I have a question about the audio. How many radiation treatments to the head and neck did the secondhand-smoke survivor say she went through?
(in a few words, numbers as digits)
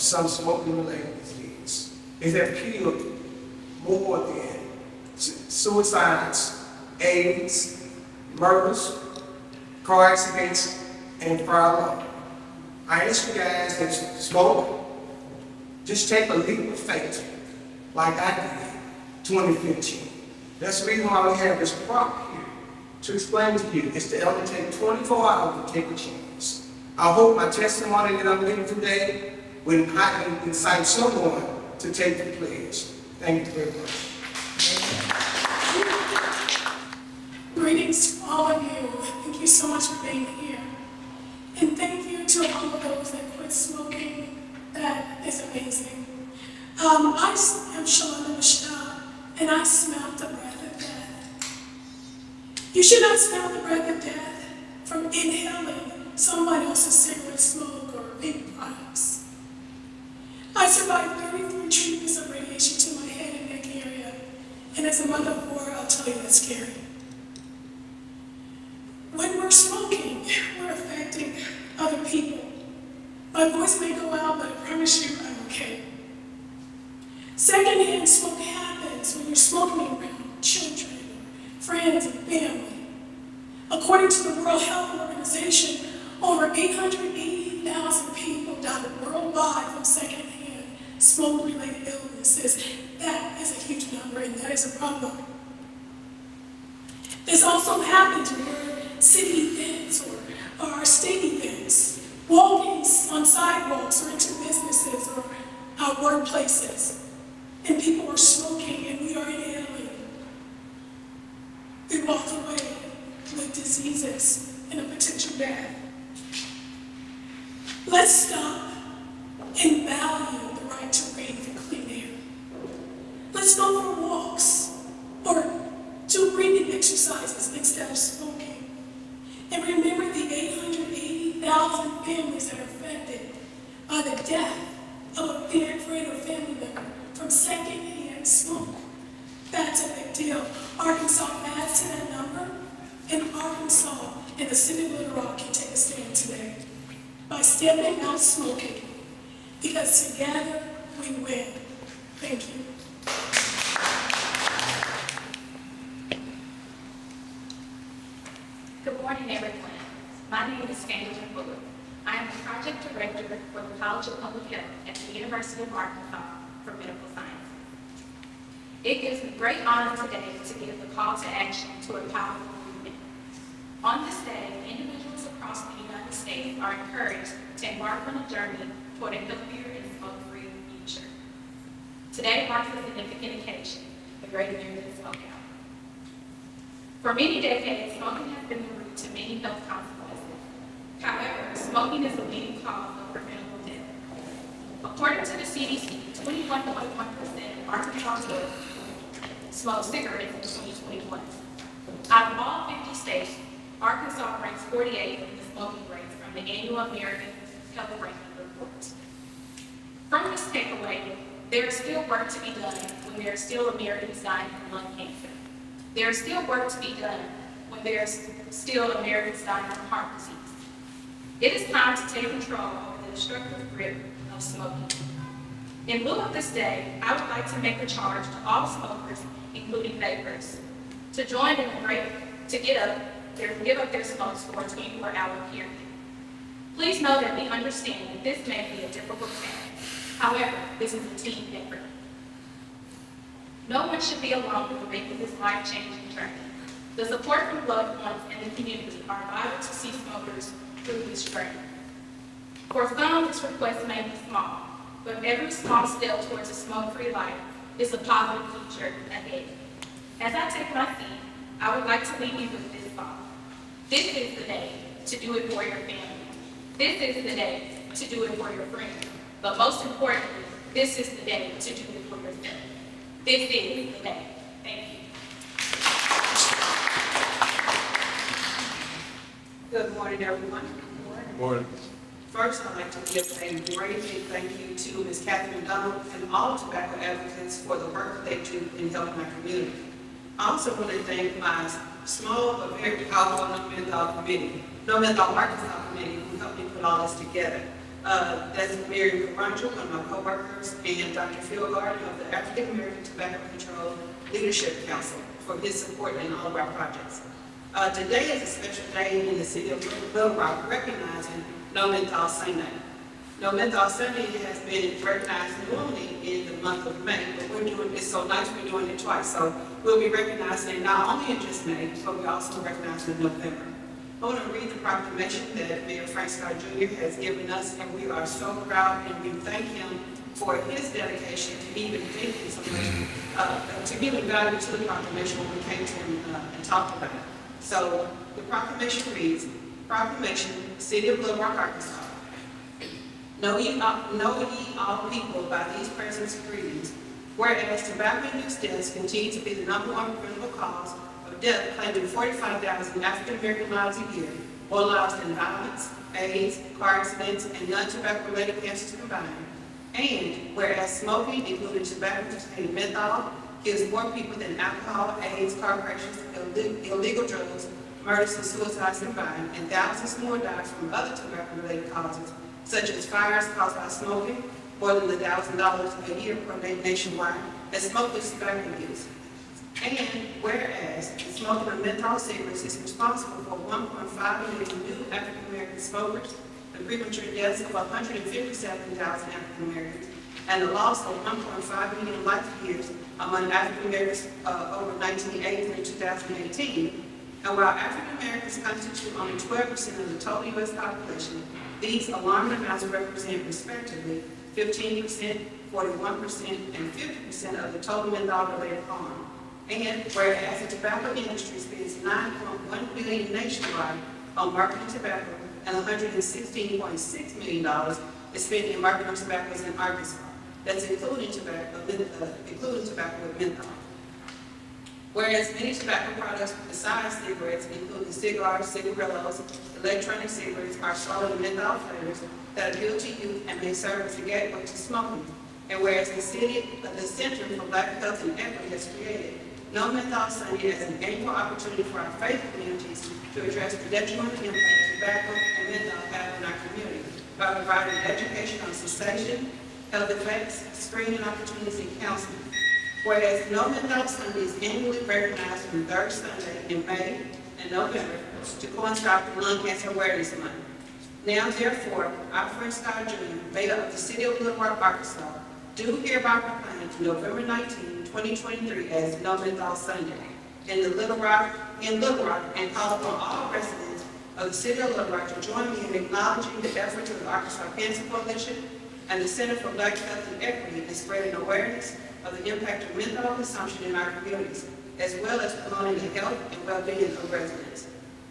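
33.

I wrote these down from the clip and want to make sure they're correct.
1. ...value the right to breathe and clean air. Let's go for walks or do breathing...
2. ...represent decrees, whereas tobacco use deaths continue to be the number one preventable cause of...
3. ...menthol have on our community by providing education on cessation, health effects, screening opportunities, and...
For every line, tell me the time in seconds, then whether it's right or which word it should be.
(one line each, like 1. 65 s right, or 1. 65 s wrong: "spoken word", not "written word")
1. 119 s right
2. 345 s wrong: "present", not "represent"
3. 445 s right.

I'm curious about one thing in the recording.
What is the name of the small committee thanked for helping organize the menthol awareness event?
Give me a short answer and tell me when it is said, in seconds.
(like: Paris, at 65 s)
No Menthol Arkansas, at 294 s.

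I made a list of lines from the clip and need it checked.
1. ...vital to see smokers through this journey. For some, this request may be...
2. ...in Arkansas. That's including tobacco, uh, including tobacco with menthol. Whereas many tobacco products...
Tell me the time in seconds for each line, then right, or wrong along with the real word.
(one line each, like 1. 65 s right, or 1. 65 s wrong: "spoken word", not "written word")
1. 249 s right
2. 419 s right.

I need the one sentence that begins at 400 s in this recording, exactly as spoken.
population, these alarming amounts represent respectively 15%, 41%, and 50% of the total menthol-related harm.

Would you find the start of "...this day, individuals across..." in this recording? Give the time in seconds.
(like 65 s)
174 s.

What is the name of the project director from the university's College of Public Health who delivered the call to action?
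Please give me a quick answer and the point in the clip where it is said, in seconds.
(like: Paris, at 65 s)
Angela Fuller, at 160 s.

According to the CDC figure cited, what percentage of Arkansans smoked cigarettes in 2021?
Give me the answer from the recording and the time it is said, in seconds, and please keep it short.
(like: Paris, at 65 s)
21.1%, at 196 s.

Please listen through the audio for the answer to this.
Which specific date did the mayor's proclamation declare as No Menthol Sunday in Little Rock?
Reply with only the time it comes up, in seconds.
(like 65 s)
466 s.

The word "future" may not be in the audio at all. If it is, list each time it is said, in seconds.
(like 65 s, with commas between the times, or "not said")
180 s, 258 s.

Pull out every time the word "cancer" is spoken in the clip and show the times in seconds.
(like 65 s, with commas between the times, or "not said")
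214 s, 358 s, 459 s, 477 s.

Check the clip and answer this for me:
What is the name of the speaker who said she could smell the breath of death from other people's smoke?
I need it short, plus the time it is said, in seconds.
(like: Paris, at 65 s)
Shalana Michelle, at 47 s.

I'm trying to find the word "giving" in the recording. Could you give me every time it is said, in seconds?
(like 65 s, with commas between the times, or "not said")
28 s, 333 s.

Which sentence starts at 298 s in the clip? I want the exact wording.
Uh, that's Mary Caranjo, one of my coworkers, and Dr.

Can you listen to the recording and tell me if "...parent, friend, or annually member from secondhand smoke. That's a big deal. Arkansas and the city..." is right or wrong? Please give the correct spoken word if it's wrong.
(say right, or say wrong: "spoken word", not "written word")
wrong: "family", not "annually".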